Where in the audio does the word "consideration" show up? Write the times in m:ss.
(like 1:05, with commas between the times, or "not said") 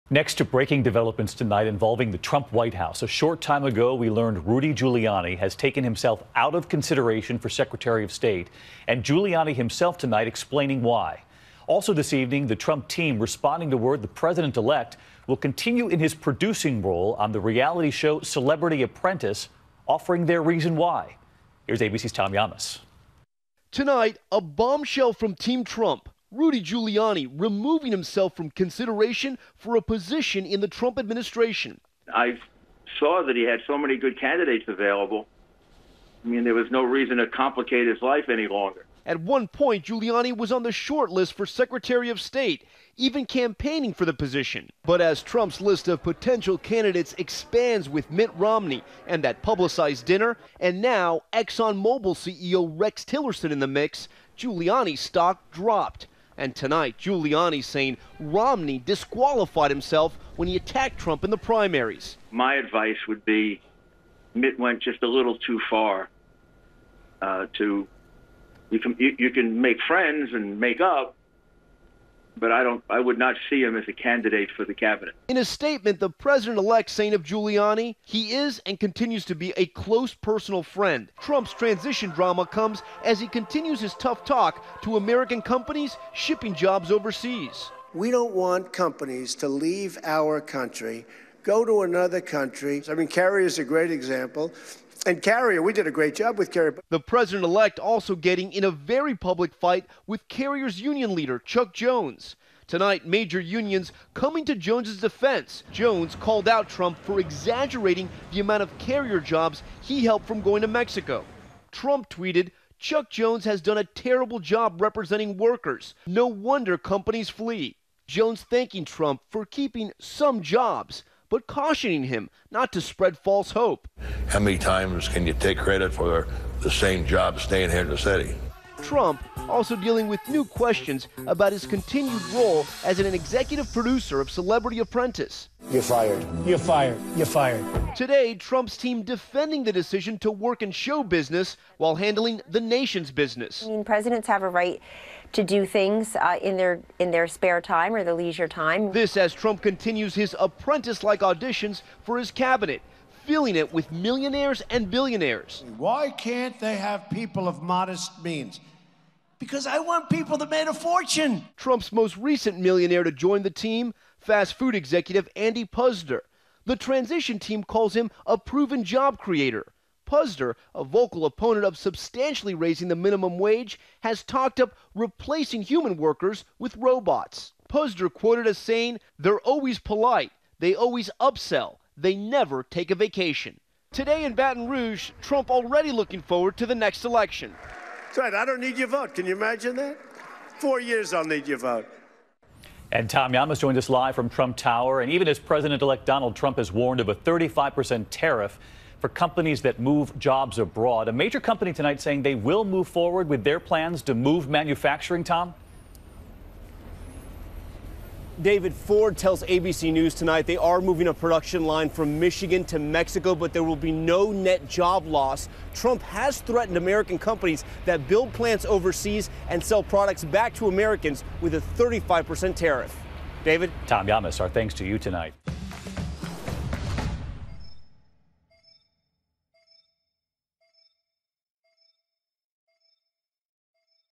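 0:06, 0:28.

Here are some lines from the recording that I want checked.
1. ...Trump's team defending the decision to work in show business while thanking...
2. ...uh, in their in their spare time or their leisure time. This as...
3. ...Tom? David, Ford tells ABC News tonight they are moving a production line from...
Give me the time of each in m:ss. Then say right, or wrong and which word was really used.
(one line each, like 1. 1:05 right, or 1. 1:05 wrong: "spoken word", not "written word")
1. 2:18 wrong: "handling", not "thanking"
2. 2:26 right
3. 3:25 right.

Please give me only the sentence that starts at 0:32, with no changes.
I saw that he had so many good candidates available.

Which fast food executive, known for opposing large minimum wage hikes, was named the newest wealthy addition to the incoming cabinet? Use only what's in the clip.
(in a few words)
Andy Puzder.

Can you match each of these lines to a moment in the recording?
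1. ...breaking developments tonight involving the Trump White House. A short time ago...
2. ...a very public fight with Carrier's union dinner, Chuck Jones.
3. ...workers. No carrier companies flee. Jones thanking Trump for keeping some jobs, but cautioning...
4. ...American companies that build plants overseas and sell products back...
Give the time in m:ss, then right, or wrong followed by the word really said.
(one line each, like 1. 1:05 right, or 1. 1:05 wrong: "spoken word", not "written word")
1. 0:00 right
2. 1:38 wrong: "leader", not "dinner"
3. 1:55 wrong: "wonder", not "carrier"
4. 3:36 right.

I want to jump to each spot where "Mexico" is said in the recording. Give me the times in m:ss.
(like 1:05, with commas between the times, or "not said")
1:50, 3:32.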